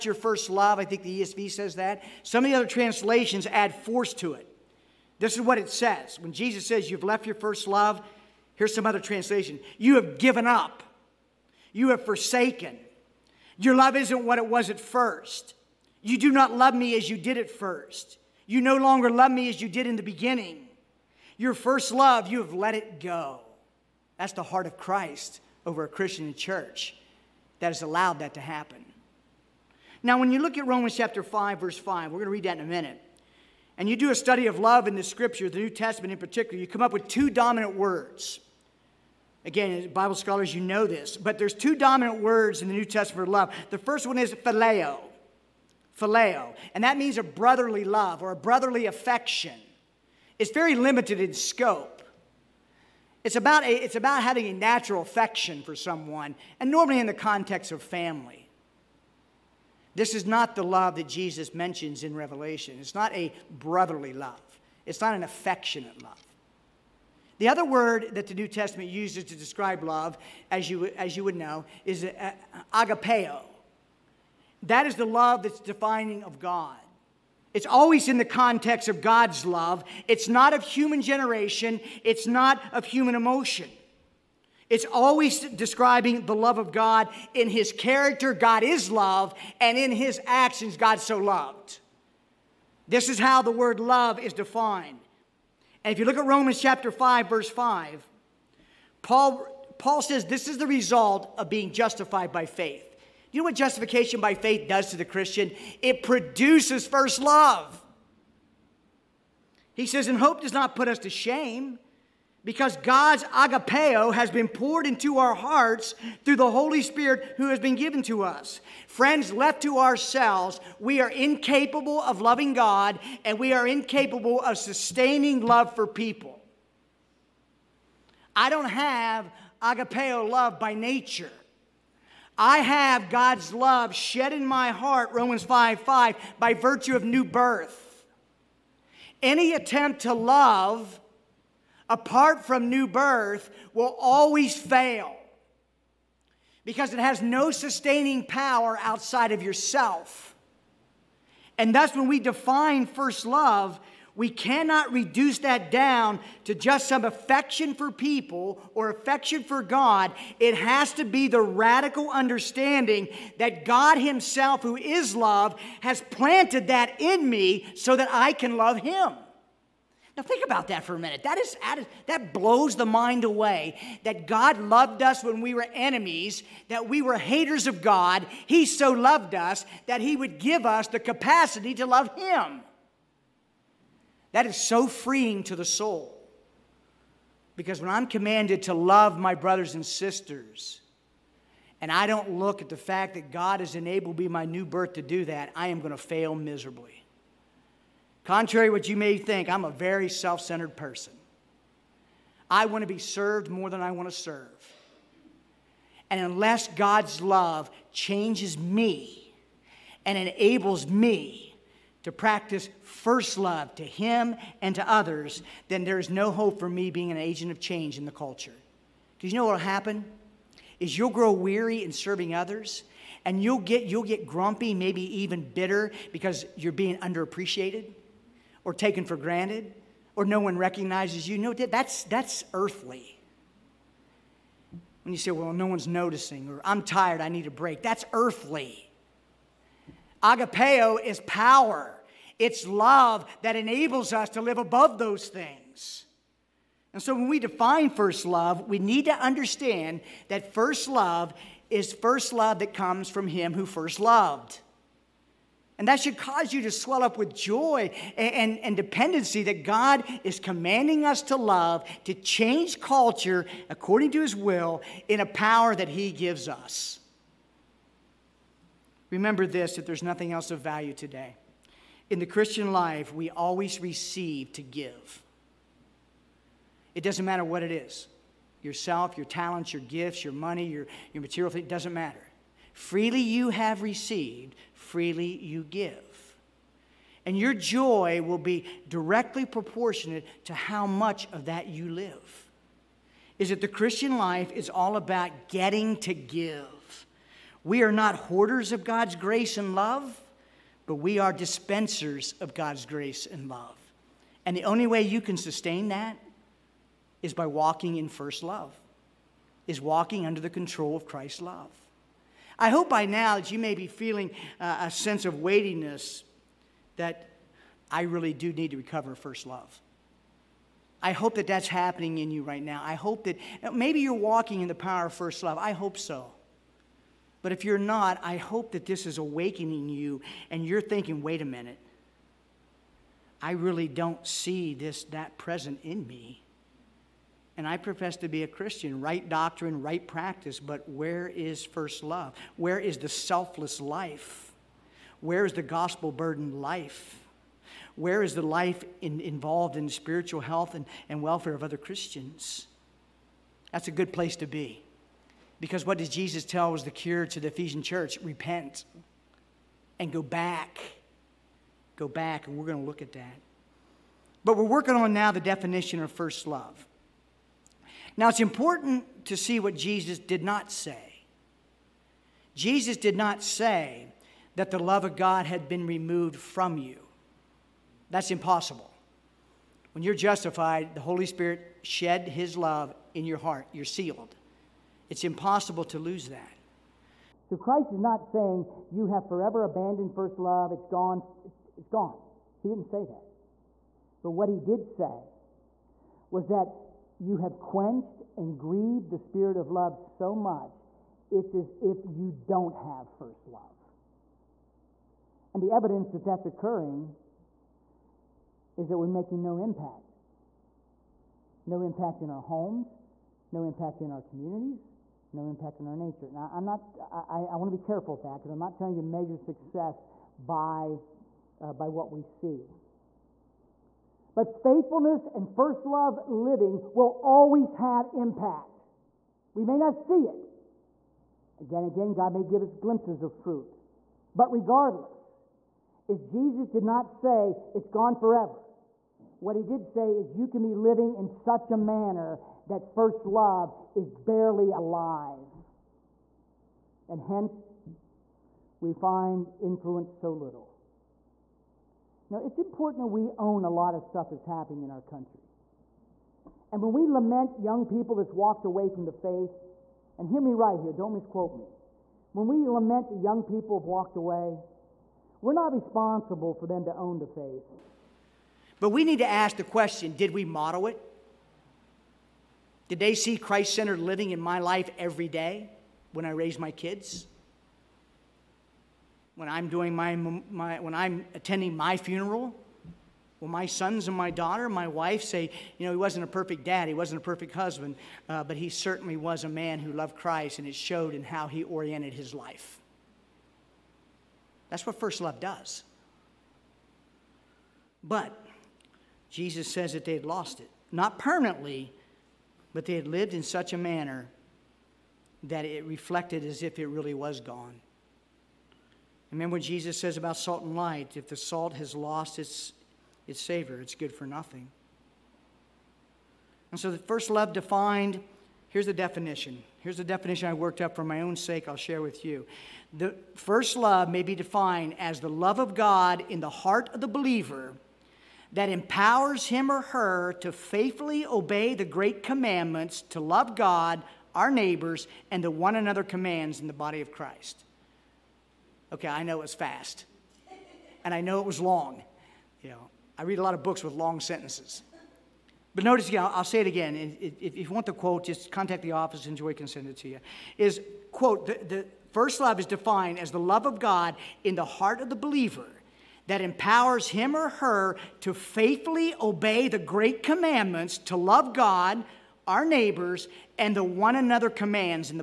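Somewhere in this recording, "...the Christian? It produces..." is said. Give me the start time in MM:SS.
01:44.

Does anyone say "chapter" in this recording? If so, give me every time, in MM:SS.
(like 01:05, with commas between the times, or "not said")
00:30, 01:36.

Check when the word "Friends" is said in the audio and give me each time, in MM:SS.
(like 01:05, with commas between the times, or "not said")
01:58.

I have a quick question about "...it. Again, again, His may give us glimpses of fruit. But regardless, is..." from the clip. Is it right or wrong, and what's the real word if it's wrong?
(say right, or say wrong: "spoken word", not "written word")
wrong: "God", not "His".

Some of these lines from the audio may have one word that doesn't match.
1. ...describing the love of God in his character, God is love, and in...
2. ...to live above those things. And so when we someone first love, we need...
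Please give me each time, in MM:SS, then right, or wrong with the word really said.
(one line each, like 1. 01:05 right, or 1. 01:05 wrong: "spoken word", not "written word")
1. 01:25 right
2. 04:04 wrong: "define", not "someone".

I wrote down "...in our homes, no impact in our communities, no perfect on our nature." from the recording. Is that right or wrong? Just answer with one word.
wrong.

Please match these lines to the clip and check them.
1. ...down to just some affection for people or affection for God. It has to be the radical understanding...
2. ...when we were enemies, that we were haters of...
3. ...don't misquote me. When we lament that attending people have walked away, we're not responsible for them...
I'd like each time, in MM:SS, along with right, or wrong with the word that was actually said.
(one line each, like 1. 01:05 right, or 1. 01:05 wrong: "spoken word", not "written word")
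1. 02:35 right
2. 02:55 right
3. 07:40 wrong: "young", not "attending".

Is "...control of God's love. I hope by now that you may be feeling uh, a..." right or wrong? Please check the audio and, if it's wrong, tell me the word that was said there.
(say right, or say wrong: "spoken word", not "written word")
wrong: "Christ", not "God".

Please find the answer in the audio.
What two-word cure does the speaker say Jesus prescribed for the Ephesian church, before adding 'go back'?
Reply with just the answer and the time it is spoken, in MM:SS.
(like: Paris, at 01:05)
Repent and go back, at 05:58.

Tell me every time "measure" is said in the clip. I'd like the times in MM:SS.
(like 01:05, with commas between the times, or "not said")
06:59.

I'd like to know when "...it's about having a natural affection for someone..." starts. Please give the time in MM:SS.
00:53.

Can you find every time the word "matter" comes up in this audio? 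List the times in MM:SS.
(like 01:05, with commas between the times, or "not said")
04:37, 04:41.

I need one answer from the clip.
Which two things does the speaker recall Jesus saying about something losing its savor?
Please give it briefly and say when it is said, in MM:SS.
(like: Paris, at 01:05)
salt and light, at 08:30.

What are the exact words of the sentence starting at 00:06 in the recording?
When Jesus says, You've left your first love, here's some other translation You have given up, you have forsaken.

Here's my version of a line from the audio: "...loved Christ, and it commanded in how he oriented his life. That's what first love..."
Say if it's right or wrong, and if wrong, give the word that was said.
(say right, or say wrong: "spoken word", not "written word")
wrong: "showed", not "commanded".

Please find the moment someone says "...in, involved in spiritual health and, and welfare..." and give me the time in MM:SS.
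05:49.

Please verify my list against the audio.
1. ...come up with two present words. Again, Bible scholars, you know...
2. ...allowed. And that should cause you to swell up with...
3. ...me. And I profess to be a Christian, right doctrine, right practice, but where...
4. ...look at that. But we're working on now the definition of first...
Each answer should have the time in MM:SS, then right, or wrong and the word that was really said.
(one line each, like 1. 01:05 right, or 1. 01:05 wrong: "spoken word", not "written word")
1. 00:36 wrong: "dominant", not "present"
2. 04:13 wrong: "loved", not "allowed"
3. 05:36 right
4. 06:02 right.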